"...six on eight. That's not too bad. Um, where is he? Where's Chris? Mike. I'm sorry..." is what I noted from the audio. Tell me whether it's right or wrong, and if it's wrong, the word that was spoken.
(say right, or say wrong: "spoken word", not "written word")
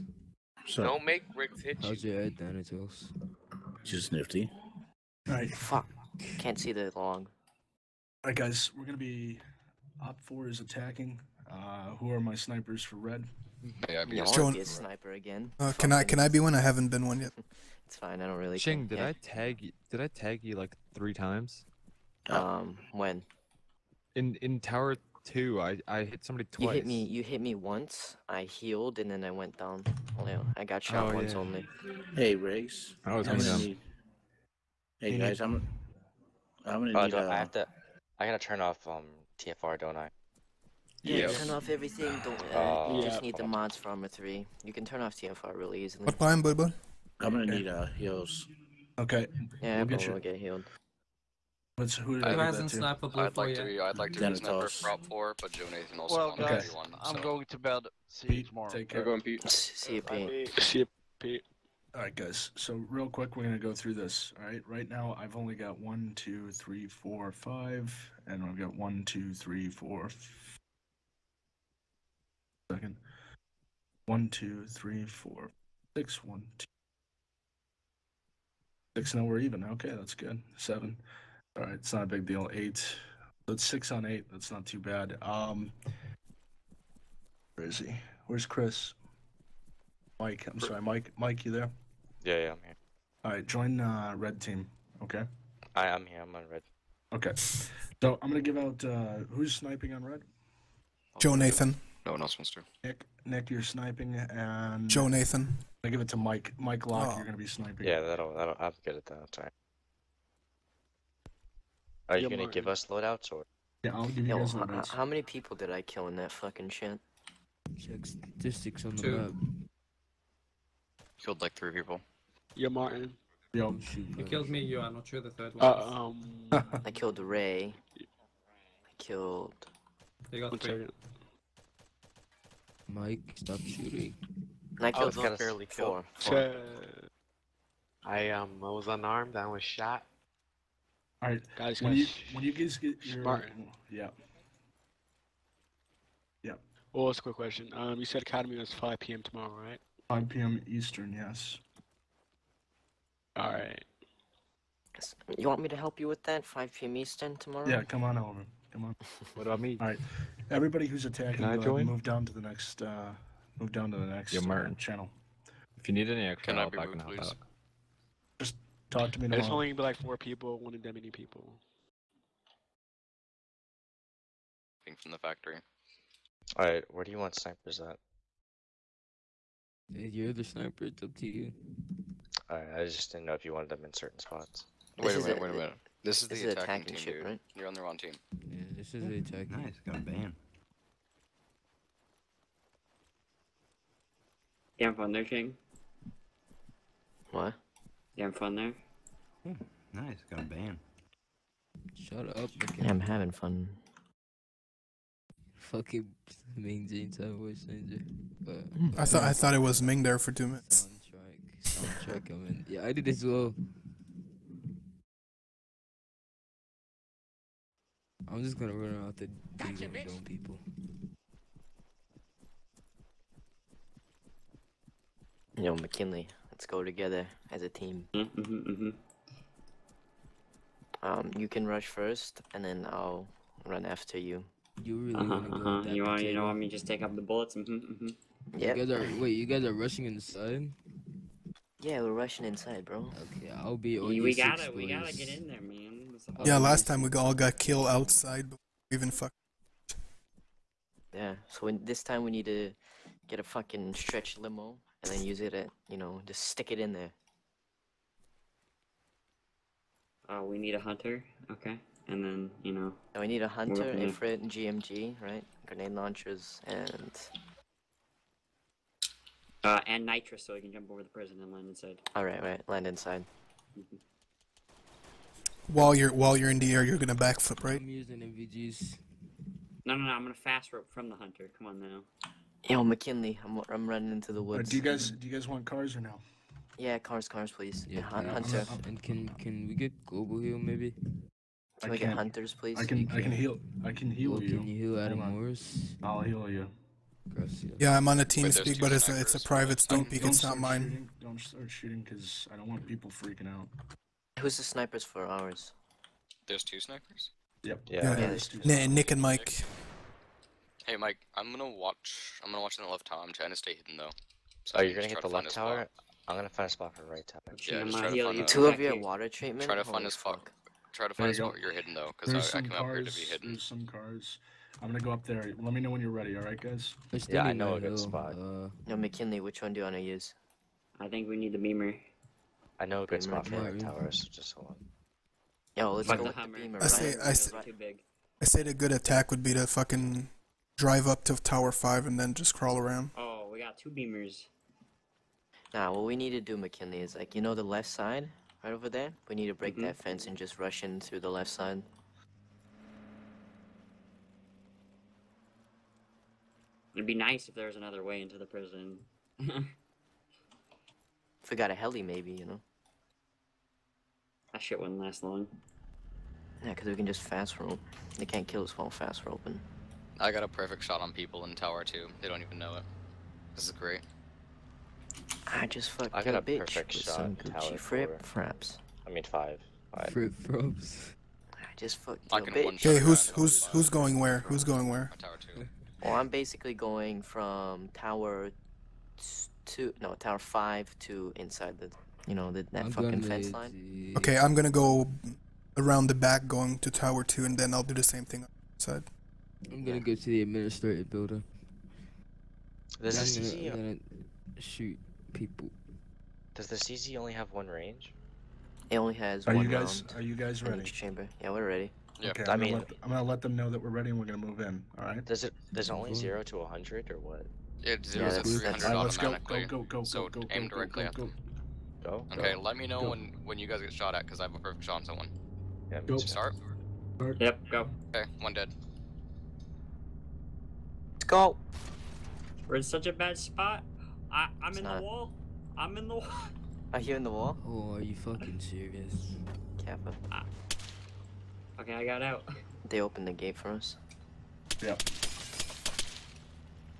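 right.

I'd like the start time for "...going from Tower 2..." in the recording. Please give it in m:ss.
6:26.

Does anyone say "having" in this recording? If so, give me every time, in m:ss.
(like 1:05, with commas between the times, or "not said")
3:18, 3:23.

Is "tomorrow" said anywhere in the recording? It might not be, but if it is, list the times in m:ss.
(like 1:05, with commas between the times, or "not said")
0:58, 2:29, 2:37, 2:49.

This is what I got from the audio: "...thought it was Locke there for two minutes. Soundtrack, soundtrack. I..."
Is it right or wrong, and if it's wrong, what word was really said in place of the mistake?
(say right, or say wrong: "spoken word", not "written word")
wrong: "Ming", not "Locke".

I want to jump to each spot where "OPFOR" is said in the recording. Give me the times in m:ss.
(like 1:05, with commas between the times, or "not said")
0:10.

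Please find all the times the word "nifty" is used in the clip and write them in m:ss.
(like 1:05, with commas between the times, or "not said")
0:04.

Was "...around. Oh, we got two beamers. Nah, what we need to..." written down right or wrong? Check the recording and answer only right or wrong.
right.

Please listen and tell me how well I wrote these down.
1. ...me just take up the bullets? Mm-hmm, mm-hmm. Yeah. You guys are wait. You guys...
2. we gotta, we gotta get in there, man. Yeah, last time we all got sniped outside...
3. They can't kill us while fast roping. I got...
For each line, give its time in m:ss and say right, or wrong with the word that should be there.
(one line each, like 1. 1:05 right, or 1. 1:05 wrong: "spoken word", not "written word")
1. 3:56 right
2. 4:04 wrong: "killed", not "sniped"
3. 6:08 right.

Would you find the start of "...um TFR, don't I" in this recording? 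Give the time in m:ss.
0:38.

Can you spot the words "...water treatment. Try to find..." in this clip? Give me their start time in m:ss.
5:18.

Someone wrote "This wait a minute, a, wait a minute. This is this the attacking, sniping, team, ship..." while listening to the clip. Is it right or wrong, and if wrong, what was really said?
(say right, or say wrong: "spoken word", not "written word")
wrong: "attacking", not "sniping".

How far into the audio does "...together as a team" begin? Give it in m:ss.
3:46.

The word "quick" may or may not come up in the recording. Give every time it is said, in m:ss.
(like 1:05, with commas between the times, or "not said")
1:03, 2:27.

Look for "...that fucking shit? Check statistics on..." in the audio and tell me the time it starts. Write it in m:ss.
1:56.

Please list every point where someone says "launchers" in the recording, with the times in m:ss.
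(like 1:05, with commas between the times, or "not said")
4:25.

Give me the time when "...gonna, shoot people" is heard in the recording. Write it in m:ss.
6:43.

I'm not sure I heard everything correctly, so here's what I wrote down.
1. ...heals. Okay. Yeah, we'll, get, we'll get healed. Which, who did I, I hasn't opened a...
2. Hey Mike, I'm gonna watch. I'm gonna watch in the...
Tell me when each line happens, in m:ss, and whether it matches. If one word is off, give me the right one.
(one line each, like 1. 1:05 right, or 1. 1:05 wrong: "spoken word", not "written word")
1. 0:47 wrong: "sniped", not "opened"
2. 5:10 right.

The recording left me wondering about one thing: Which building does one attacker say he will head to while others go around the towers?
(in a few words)
Administrative building.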